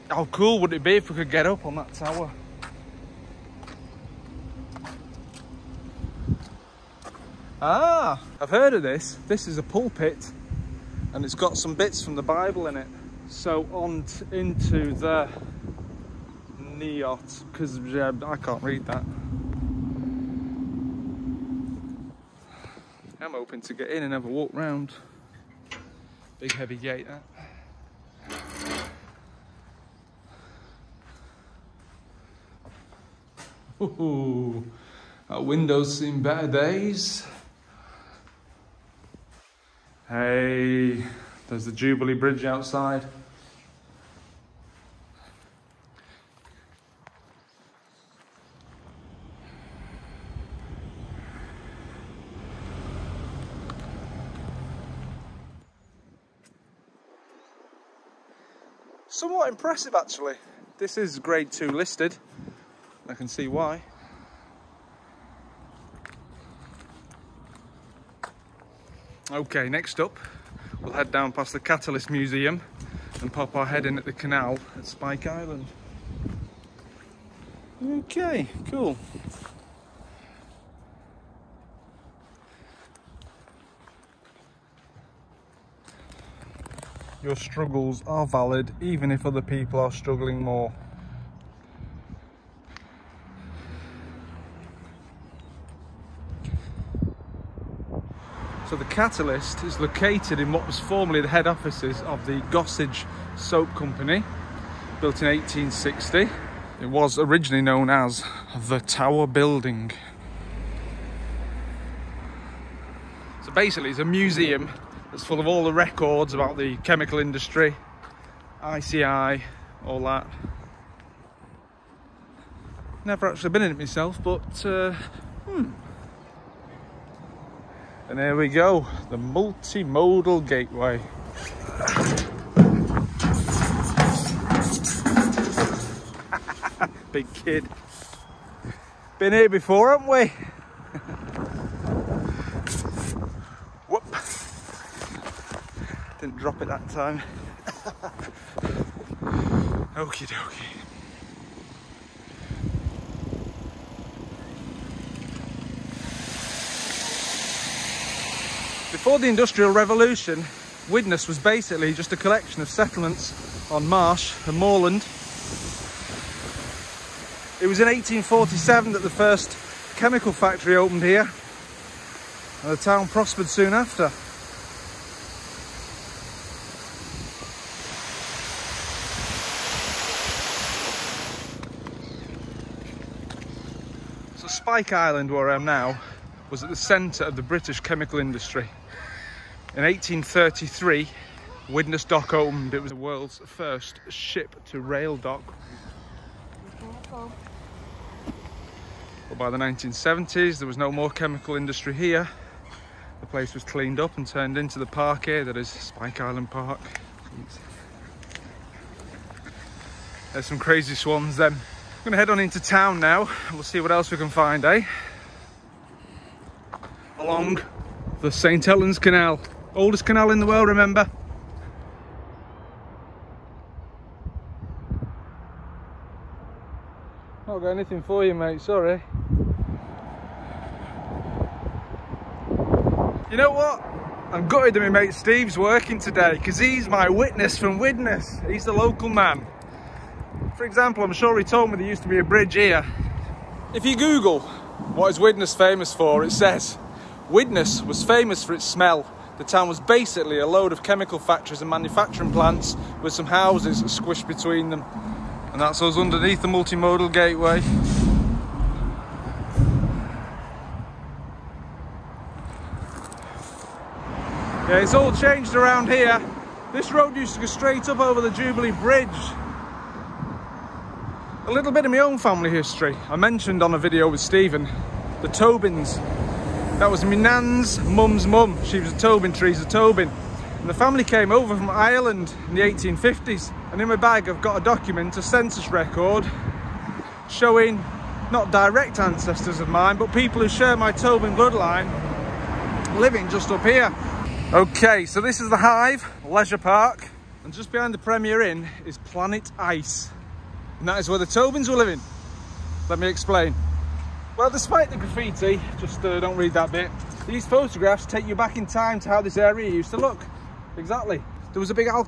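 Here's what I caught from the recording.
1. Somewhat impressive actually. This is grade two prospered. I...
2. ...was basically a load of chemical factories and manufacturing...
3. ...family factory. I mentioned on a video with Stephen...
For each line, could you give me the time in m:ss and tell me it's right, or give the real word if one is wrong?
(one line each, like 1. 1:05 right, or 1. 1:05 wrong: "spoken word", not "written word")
1. 0:59 wrong: "listed", not "prospered"
2. 4:09 right
3. 4:32 wrong: "history", not "factory".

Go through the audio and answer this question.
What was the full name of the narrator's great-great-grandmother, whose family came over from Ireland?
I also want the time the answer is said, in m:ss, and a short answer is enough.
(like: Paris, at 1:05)
Teresa Tobin, at 4:39.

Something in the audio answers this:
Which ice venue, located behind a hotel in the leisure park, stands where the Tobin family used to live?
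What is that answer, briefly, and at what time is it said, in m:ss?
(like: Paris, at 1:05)
Planet Ice, at 4:58.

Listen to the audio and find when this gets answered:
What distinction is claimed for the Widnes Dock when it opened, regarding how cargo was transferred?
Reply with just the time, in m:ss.
3:12.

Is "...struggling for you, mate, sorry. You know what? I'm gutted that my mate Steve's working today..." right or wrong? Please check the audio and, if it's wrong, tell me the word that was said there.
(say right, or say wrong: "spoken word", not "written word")
wrong: "anything", not "struggling".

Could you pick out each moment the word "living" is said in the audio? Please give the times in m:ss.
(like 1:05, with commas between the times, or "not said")
4:52, 5:01.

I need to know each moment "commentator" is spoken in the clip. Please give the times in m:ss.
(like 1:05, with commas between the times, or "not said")
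not said.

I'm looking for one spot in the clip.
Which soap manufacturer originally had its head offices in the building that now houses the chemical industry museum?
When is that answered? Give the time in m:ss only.
1:42.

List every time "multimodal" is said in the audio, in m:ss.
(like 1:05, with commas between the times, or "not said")
2:09, 4:16.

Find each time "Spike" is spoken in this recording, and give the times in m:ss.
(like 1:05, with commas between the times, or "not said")
1:14, 3:04, 3:25.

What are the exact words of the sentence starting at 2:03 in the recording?
Never actually been in it myself, but uh, hmm.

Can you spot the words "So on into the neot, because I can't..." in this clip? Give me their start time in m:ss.
0:13.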